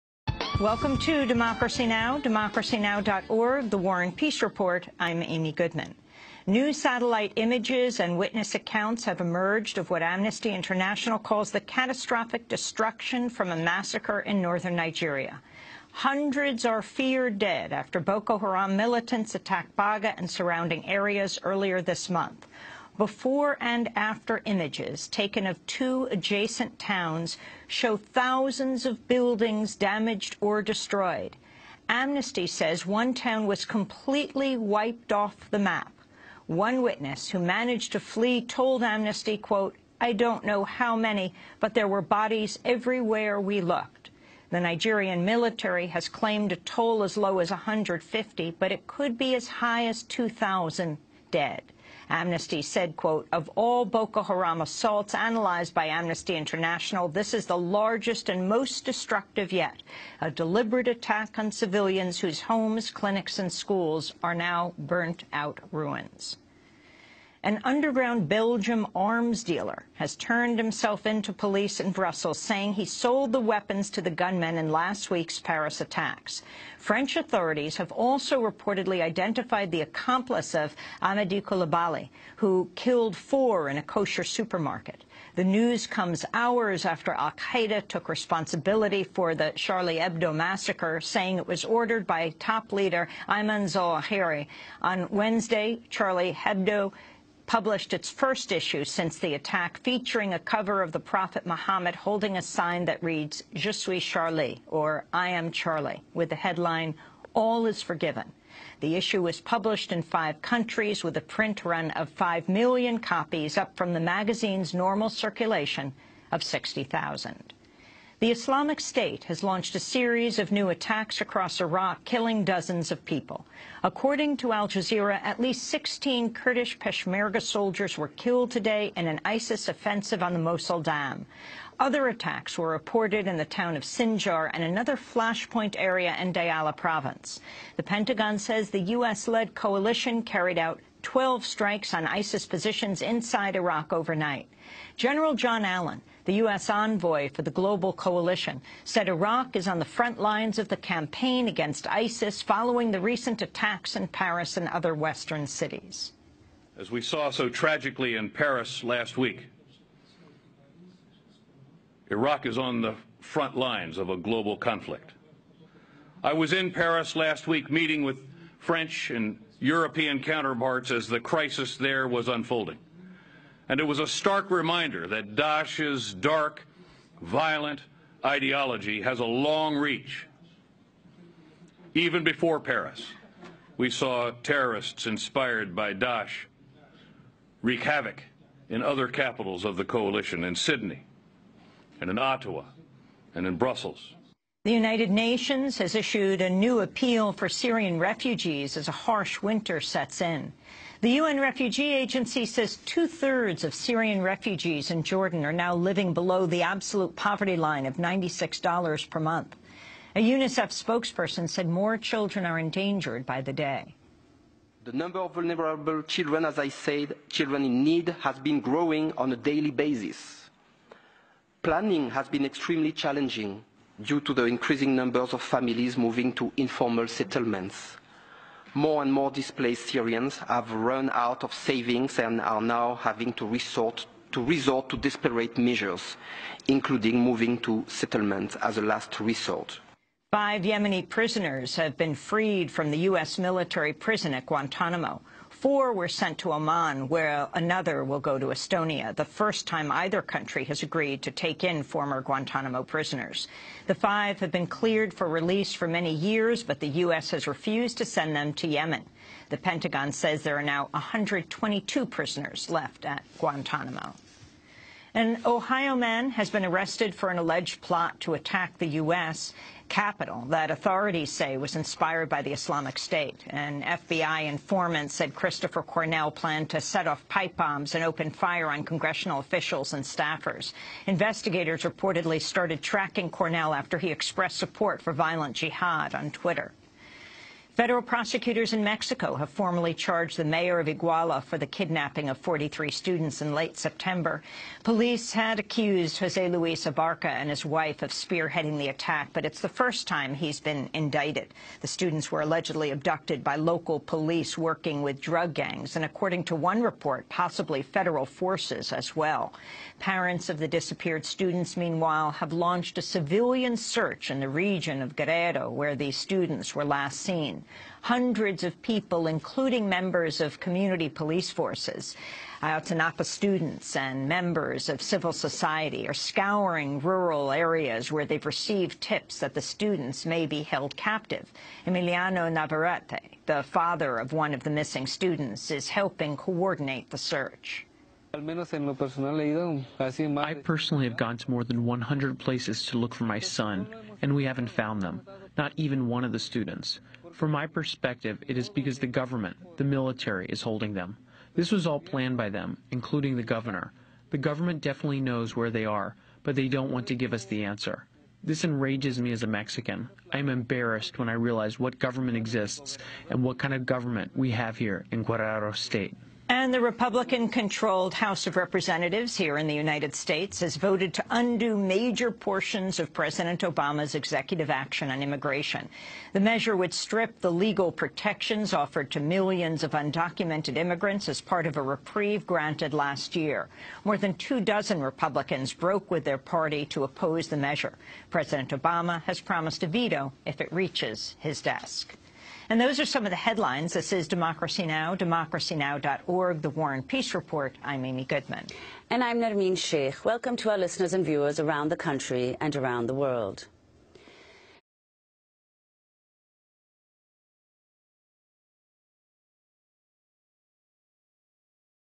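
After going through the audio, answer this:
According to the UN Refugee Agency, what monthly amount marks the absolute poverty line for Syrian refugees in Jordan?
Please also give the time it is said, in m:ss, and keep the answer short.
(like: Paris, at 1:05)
$96, at 3:27.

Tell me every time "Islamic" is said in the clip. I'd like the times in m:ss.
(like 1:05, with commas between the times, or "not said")
1:58, 4:32.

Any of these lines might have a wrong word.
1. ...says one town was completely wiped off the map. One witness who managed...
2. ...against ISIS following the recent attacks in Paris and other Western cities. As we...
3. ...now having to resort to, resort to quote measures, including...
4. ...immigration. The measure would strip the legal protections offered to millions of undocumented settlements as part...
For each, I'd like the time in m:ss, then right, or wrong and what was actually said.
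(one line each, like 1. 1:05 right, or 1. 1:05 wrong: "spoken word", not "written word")
1. 0:32 right
2. 2:31 right
3. 3:52 wrong: "desperate", not "quote"
4. 6:15 wrong: "immigrants", not "settlements".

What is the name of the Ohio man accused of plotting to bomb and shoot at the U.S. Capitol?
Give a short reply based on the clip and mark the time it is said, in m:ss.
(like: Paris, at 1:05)
Christopher Cornell, at 4:35.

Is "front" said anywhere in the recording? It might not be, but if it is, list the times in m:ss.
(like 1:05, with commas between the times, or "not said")
2:29, 2:43.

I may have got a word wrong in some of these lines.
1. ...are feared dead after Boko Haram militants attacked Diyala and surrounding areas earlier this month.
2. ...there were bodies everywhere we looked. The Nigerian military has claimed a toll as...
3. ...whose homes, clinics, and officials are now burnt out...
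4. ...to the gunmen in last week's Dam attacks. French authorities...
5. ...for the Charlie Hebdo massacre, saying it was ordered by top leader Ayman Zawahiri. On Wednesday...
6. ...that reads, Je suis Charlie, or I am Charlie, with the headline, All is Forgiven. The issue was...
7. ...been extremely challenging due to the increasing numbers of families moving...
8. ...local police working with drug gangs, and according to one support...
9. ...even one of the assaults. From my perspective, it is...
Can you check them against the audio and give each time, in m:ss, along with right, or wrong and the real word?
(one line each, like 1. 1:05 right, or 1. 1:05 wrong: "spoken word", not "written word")
1. 0:16 wrong: "Baga", not "Diyala"
2. 0:41 right
3. 1:02 wrong: "schools", not "officials"
4. 1:13 wrong: "Paris", not "Dam"
5. 1:29 right
6. 1:42 right
7. 3:42 right
8. 5:03 wrong: "report", not "support"
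9. 5:45 wrong: "students", not "assaults".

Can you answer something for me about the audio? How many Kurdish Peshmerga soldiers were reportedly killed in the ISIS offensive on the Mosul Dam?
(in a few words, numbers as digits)
16.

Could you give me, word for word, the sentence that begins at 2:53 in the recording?
And it was a stark reminder that Daesh's dark, violent ideology has a long reach.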